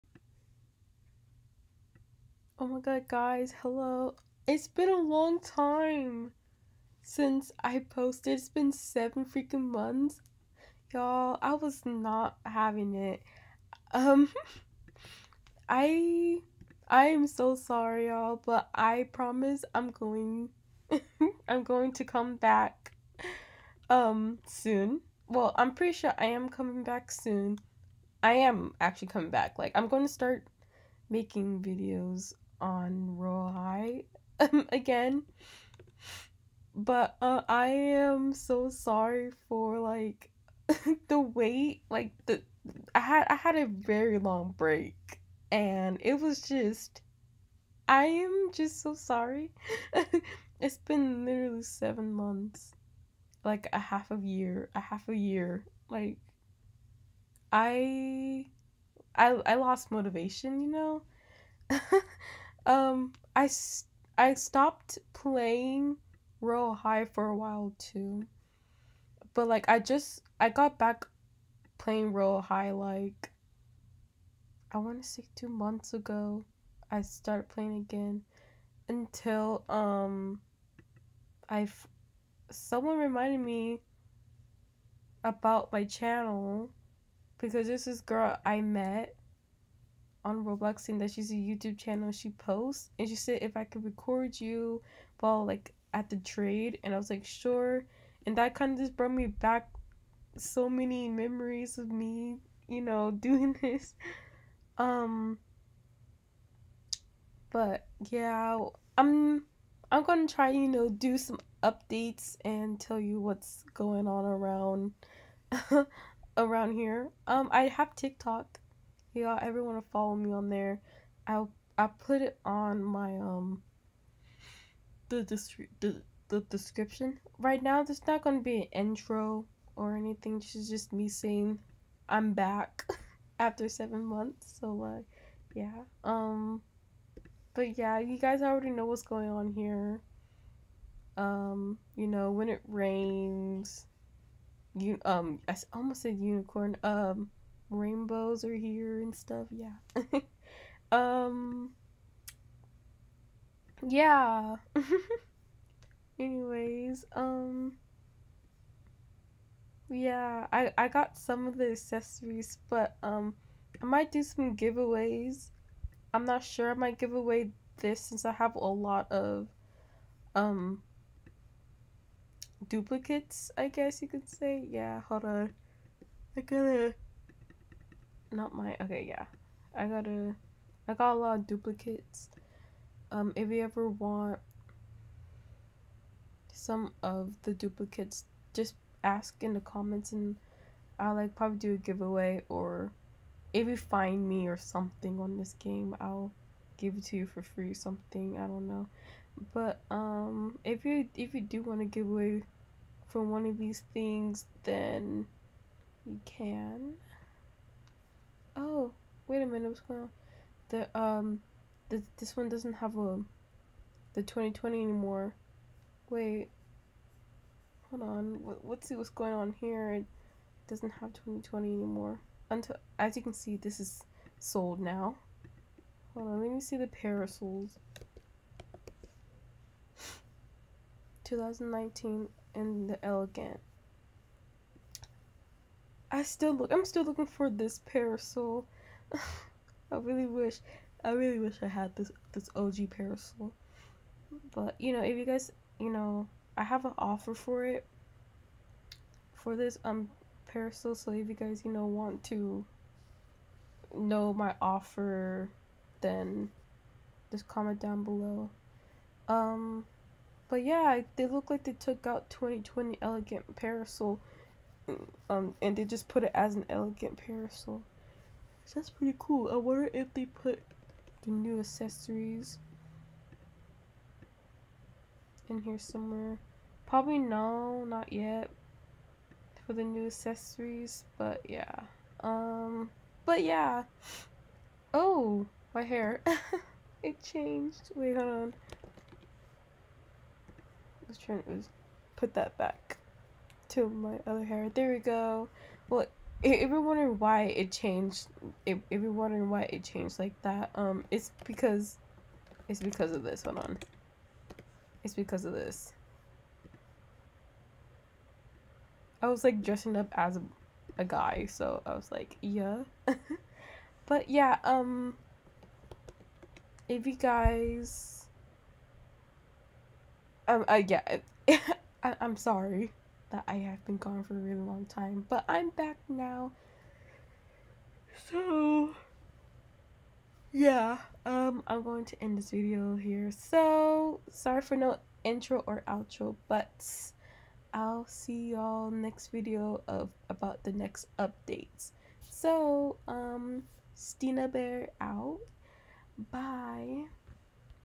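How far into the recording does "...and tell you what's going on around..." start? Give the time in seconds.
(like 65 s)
112 s.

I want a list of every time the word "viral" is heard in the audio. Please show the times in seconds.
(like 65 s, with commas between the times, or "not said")
not said.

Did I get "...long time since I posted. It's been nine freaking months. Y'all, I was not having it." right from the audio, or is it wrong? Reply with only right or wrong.
wrong.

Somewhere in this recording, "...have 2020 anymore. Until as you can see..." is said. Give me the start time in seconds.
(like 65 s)
220 s.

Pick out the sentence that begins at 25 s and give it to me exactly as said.
Well, I'm pretty sure I am coming back soon.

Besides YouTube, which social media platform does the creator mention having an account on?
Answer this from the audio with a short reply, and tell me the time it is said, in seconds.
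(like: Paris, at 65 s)
TikTok, at 117 s.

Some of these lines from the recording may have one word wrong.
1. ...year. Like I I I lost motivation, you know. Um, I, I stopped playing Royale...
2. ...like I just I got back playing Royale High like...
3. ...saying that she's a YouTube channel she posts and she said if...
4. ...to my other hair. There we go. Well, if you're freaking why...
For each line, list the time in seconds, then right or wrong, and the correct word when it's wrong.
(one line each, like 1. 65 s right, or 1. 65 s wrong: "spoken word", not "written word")
1. 55 s right
2. 69 s right
3. 90 s right
4. 293 s wrong: "wondering", not "freaking".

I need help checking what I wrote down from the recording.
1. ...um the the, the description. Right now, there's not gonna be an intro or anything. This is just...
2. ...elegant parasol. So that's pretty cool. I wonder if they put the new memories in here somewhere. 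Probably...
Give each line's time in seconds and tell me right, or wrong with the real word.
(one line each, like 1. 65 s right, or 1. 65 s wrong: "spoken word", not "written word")
1. 123 s right
2. 266 s wrong: "accessories", not "memories".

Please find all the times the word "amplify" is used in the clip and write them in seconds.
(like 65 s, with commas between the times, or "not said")
not said.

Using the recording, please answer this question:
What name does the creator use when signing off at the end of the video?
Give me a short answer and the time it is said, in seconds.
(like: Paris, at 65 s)
Stina Bear, at 343 s.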